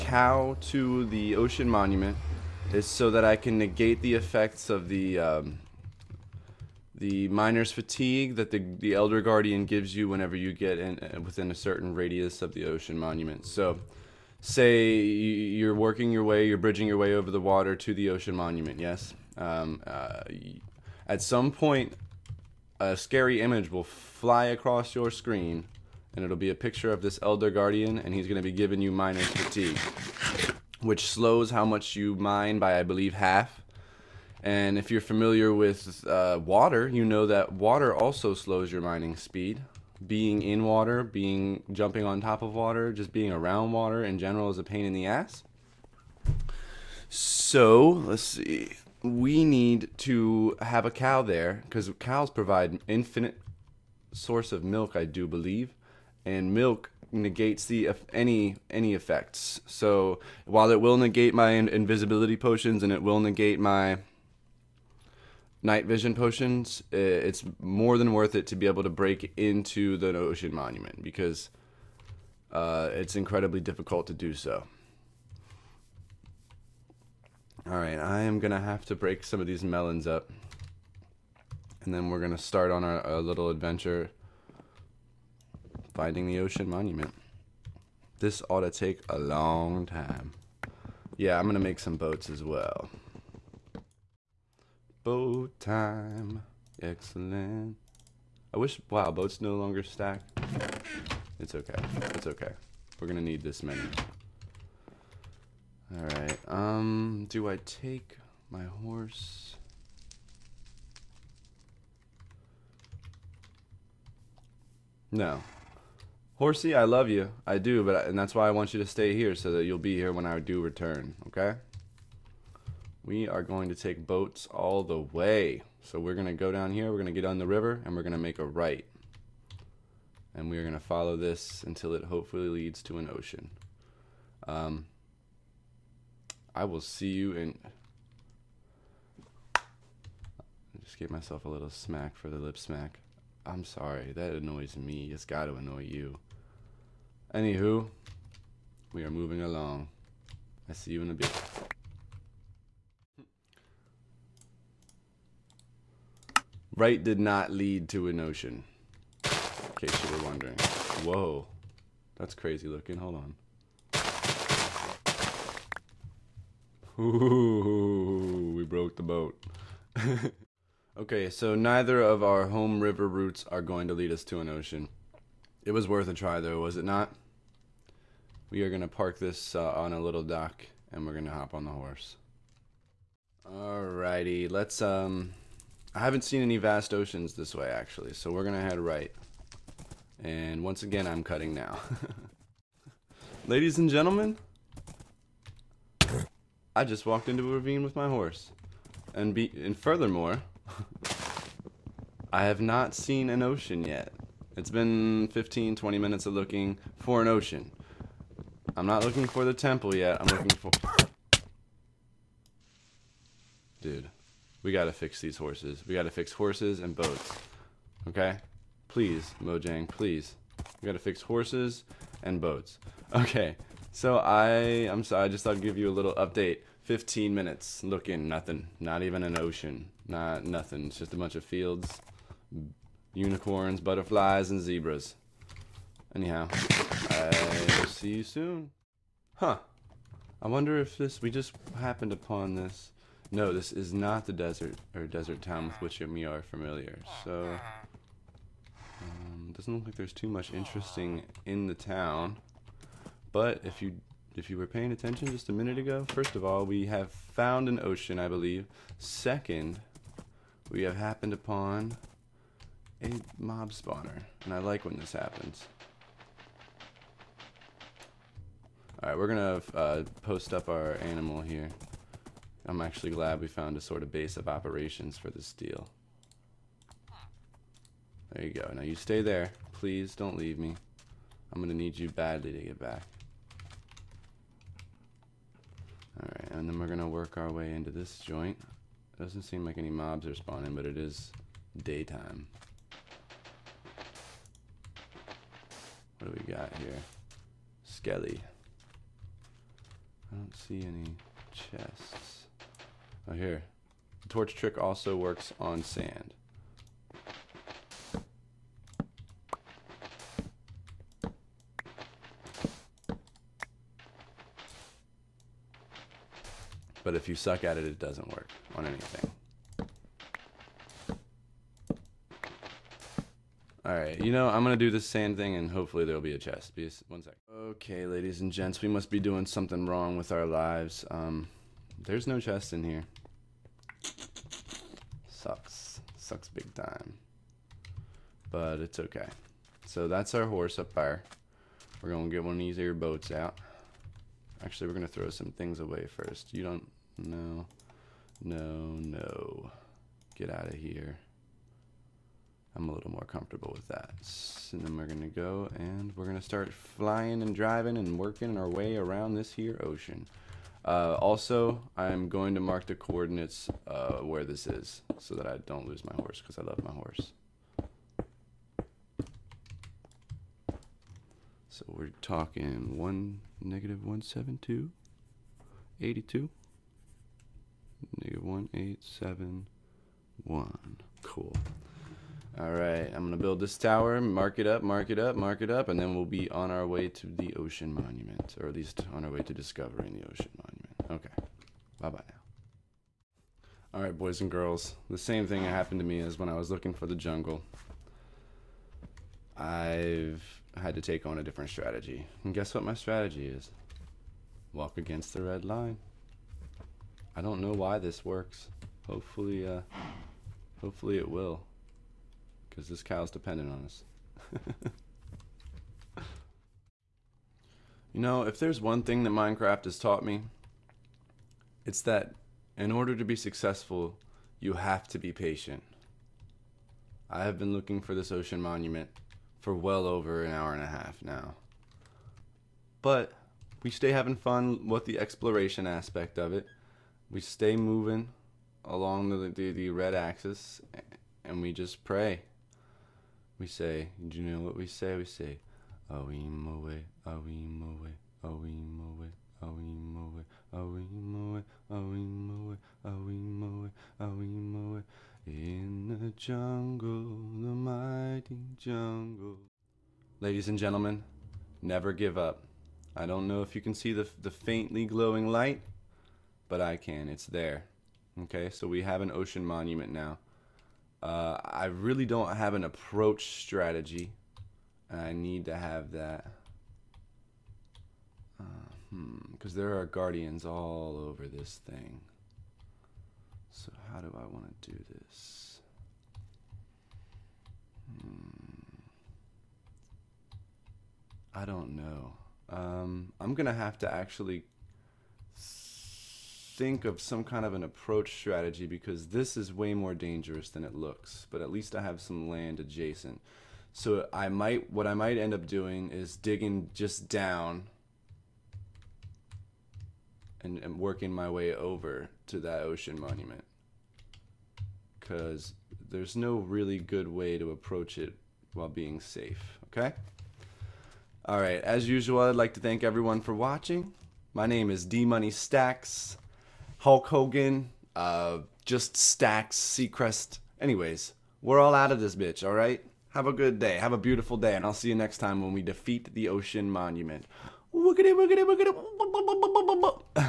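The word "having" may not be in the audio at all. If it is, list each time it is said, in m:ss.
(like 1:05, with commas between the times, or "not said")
7:14.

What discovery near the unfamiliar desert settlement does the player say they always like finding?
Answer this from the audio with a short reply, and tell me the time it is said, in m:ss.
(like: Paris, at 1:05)
mob spawner, at 4:23.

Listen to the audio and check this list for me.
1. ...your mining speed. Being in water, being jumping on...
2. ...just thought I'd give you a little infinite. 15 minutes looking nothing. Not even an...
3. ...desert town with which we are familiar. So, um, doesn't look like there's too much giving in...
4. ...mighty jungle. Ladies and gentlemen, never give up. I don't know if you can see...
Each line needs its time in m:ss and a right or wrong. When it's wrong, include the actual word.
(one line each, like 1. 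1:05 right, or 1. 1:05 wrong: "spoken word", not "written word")
1. 0:38 right
2. 3:45 wrong: "update", not "infinite"
3. 4:05 wrong: "interesting", not "giving"
4. 7:37 right.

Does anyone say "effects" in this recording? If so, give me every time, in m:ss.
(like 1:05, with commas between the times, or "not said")
0:04, 0:58.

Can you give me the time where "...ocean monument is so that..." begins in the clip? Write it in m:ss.
0:01.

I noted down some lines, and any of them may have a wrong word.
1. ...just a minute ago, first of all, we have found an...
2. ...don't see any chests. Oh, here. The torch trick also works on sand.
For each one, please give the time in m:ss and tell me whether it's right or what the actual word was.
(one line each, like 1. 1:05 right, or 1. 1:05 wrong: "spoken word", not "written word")
1. 4:15 right
2. 5:00 right.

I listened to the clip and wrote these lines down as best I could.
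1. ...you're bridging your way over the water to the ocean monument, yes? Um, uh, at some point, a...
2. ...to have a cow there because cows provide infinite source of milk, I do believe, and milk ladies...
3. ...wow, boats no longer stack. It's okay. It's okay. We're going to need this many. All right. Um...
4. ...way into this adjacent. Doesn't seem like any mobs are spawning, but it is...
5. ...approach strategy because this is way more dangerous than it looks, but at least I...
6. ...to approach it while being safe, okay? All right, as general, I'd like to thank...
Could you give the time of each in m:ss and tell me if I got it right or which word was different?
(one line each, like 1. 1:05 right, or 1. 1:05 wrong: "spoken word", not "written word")
1. 0:16 right
2. 0:49 wrong: "negates", not "ladies"
3. 1:38 right
4. 4:47 wrong: "joint", not "adjacent"
5. 8:17 right
6. 8:37 wrong: "usual", not "general".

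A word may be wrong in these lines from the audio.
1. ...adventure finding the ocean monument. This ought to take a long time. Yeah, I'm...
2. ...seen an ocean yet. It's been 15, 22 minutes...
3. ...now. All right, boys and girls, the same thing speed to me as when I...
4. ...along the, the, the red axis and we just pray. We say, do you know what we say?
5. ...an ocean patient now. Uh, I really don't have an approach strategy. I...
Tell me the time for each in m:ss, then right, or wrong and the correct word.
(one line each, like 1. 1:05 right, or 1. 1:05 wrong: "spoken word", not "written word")
1. 1:23 right
2. 3:22 wrong: "20", not "22"
3. 6:32 wrong: "happened", not "speed"
4. 7:18 right
5. 7:49 wrong: "monument", not "patient".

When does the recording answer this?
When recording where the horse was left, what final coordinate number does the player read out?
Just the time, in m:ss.
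6:18.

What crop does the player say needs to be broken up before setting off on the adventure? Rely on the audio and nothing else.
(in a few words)
melons.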